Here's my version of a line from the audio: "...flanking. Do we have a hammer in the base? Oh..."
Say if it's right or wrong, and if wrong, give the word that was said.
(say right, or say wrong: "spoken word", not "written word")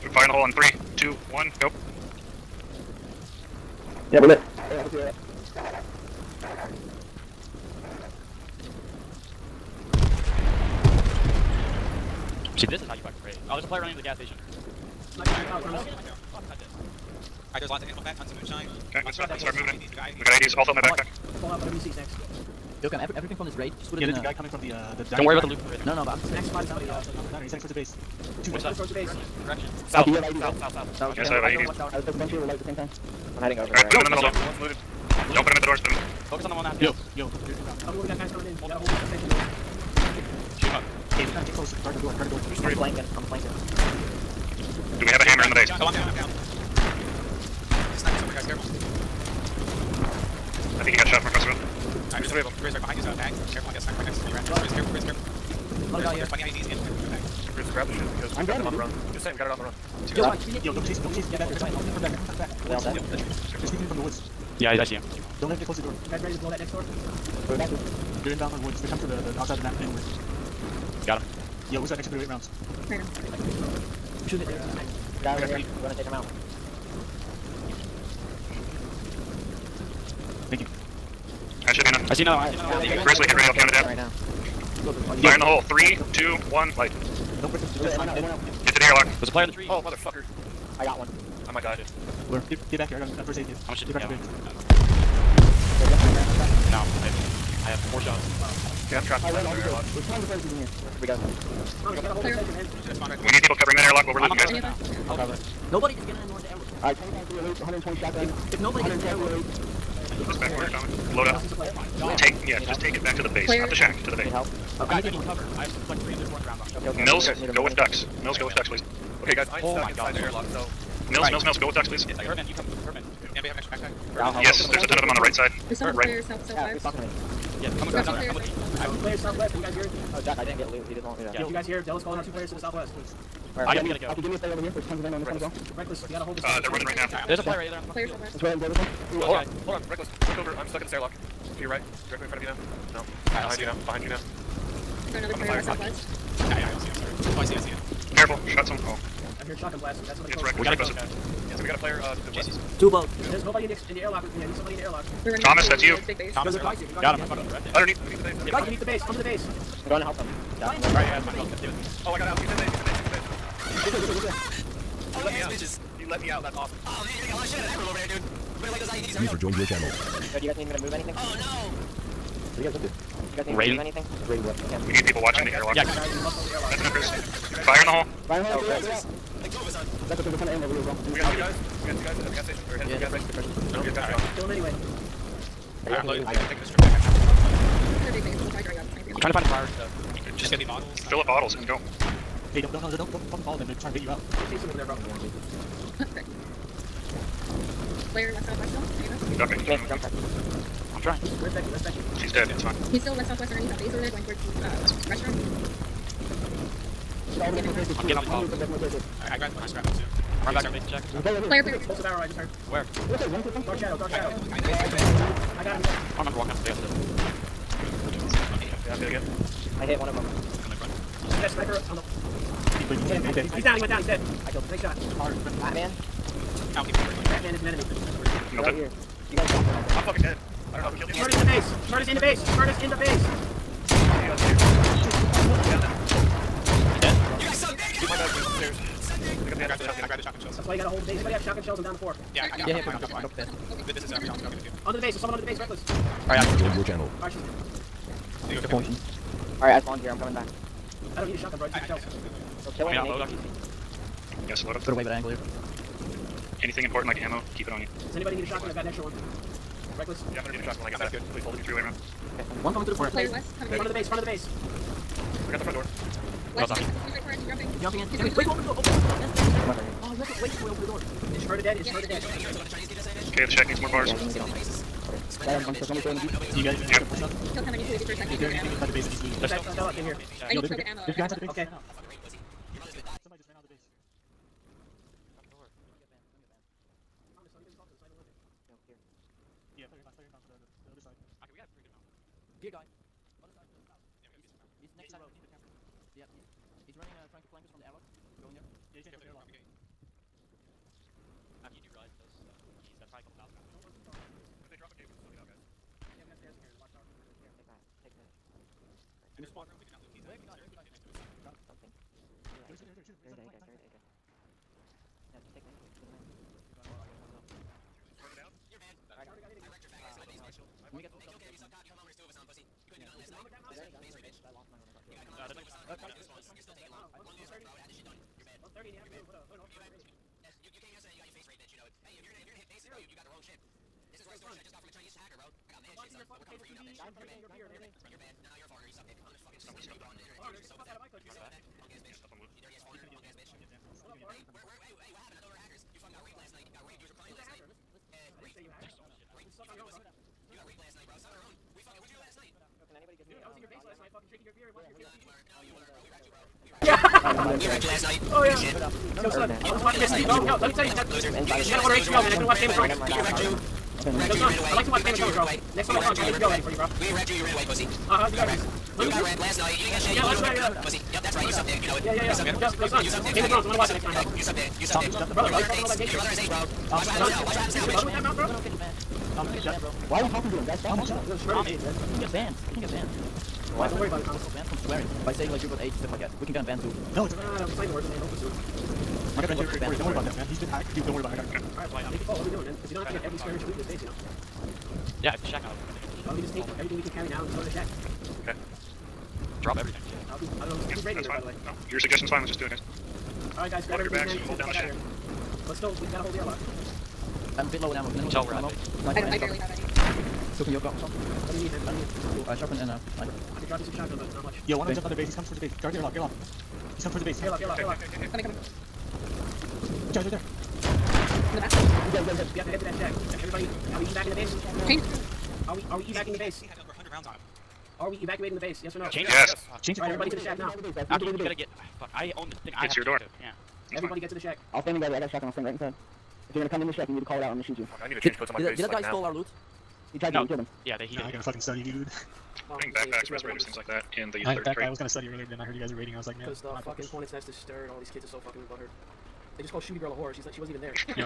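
right.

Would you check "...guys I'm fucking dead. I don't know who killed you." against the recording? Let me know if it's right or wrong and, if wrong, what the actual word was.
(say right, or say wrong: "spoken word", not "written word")
right.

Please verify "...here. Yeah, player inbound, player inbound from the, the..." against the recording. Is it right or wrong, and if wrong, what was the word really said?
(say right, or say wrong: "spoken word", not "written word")
right.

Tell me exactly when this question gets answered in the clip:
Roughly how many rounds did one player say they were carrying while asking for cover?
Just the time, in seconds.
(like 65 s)
115 s.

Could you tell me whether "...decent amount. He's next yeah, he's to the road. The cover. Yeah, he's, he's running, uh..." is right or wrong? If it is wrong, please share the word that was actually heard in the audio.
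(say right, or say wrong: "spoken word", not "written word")
wrong: "camper", not "cover".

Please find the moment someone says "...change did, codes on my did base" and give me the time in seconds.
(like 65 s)
438 s.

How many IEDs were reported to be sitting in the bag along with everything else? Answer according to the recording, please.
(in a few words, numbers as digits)
20.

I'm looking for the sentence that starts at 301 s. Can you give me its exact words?
Aki, you do realize those that's probably a couple thousand.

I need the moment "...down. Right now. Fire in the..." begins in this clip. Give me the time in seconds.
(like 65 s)
83 s.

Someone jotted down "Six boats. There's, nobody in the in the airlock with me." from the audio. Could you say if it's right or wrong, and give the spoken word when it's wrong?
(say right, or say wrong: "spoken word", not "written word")
wrong: "Two", not "Six".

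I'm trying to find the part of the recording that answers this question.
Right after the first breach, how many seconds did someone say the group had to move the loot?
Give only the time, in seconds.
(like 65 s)
20 s.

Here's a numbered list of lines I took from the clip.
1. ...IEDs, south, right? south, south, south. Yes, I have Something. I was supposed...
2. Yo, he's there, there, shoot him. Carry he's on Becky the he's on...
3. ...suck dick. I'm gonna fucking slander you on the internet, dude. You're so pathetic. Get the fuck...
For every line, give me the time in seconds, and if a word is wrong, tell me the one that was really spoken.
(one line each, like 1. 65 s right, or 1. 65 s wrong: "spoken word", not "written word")
1. 30 s wrong: "IEDs", not "Something"
2. 312 s wrong: "Carry", not "Becky"
3. 338 s right.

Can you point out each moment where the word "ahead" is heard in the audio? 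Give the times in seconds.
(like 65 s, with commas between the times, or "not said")
138 s.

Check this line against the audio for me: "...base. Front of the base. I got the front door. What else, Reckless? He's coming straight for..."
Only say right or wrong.
wrong.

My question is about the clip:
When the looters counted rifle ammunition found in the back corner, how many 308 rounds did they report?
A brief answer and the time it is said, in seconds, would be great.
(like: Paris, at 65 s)
25, at 106 s.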